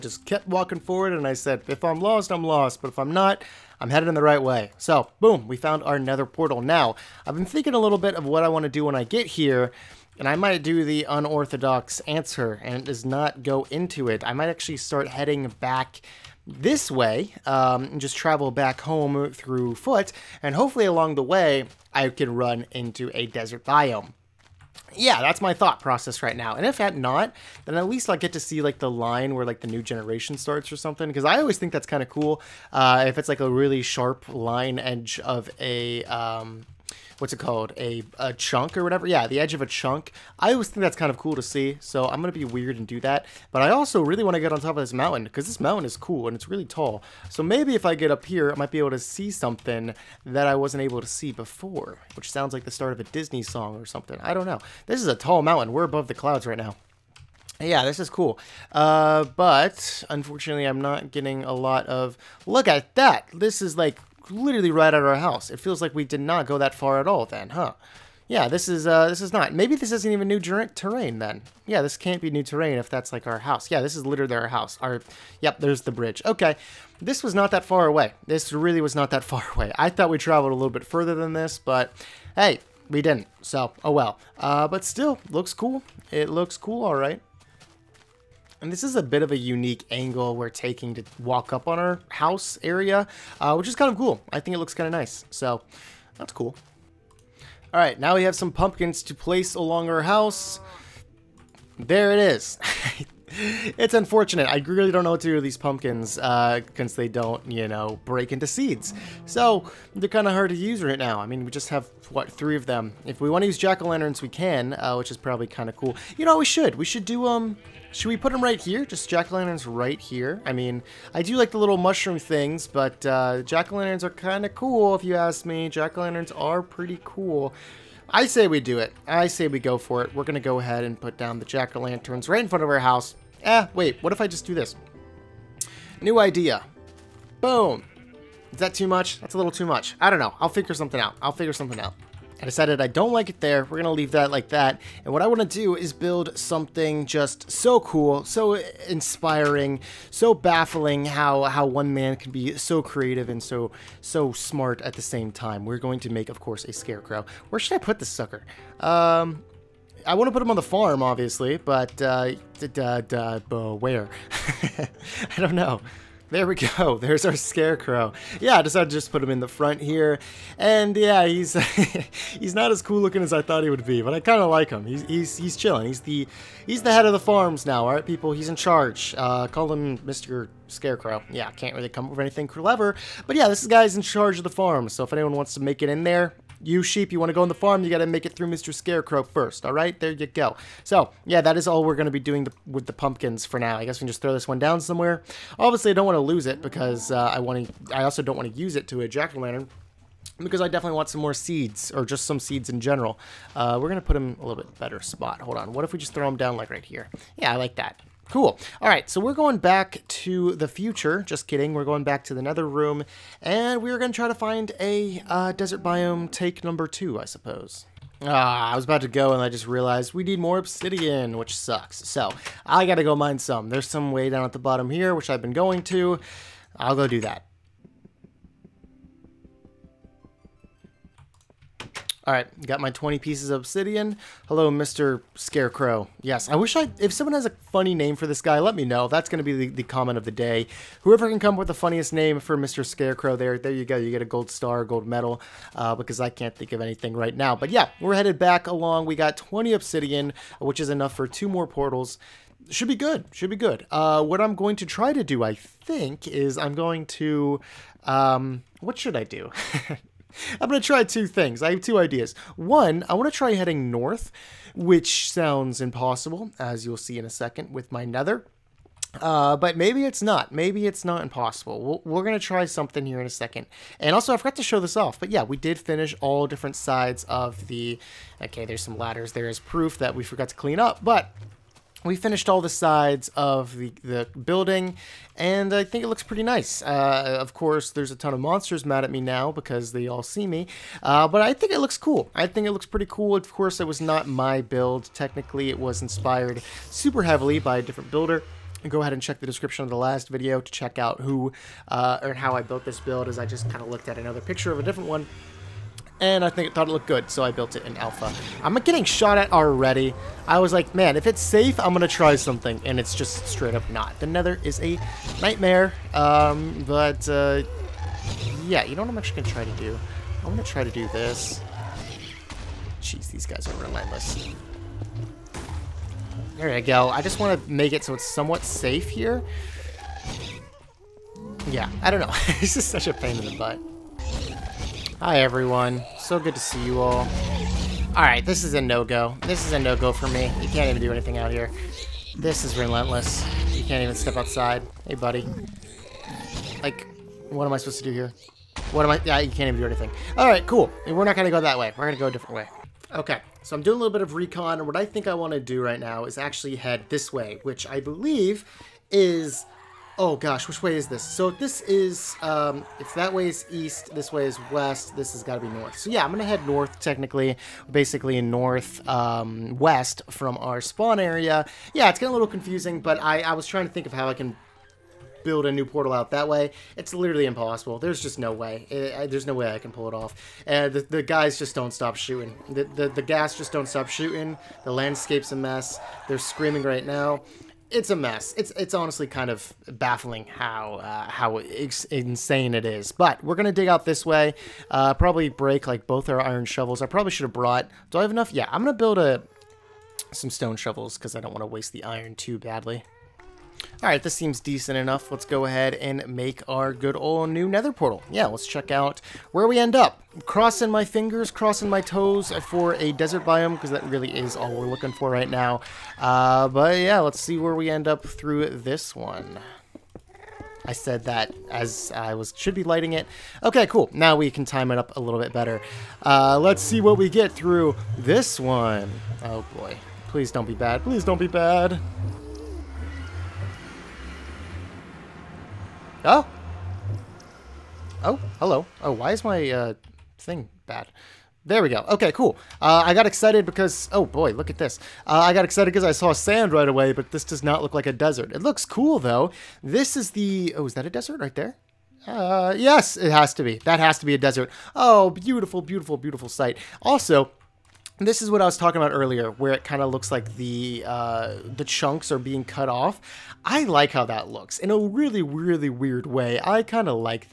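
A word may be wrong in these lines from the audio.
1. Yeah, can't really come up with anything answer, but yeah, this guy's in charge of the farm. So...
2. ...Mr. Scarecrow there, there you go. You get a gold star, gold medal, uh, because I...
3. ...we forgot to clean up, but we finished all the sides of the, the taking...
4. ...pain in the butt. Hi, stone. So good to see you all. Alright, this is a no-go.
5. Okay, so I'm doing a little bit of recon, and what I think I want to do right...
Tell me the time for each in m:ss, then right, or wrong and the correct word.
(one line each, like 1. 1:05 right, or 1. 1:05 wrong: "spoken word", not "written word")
1. 3:01 wrong: "clever", not "answer"
2. 4:02 right
3. 4:40 wrong: "building", not "taking"
4. 5:33 wrong: "everyone", not "stone"
5. 5:53 right.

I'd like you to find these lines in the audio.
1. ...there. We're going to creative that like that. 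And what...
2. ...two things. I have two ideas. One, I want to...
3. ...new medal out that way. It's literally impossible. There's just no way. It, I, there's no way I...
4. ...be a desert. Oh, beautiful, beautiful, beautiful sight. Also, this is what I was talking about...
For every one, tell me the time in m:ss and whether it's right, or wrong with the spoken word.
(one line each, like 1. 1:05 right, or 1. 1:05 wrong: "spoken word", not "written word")
1. 2:23 wrong: "leave", not "creative"
2. 4:21 right
3. 6:15 wrong: "portal", not "medal"
4. 7:34 right.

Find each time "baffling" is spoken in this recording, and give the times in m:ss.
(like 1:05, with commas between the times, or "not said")
2:30, 6:29.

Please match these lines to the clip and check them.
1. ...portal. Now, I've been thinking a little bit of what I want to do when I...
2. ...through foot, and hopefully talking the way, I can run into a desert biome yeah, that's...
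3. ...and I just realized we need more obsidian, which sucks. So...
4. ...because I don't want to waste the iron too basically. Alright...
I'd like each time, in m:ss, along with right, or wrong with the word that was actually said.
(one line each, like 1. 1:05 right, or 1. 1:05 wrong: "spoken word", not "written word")
1. 0:06 right
2. 0:19 wrong: "along", not "talking"
3. 3:39 right
4. 6:41 wrong: "badly", not "basically".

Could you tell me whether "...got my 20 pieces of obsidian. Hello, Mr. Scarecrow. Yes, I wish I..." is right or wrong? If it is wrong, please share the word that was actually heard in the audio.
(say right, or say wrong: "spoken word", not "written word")
right.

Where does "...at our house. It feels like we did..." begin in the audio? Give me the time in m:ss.
1:04.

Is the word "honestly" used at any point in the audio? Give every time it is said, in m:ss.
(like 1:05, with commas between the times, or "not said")
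6:28.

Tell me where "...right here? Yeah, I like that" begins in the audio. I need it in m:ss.
3:26.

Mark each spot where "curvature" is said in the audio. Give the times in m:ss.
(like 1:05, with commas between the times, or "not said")
not said.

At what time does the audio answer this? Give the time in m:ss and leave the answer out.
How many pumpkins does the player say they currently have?
1:52.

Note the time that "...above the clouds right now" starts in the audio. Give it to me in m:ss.
0:55.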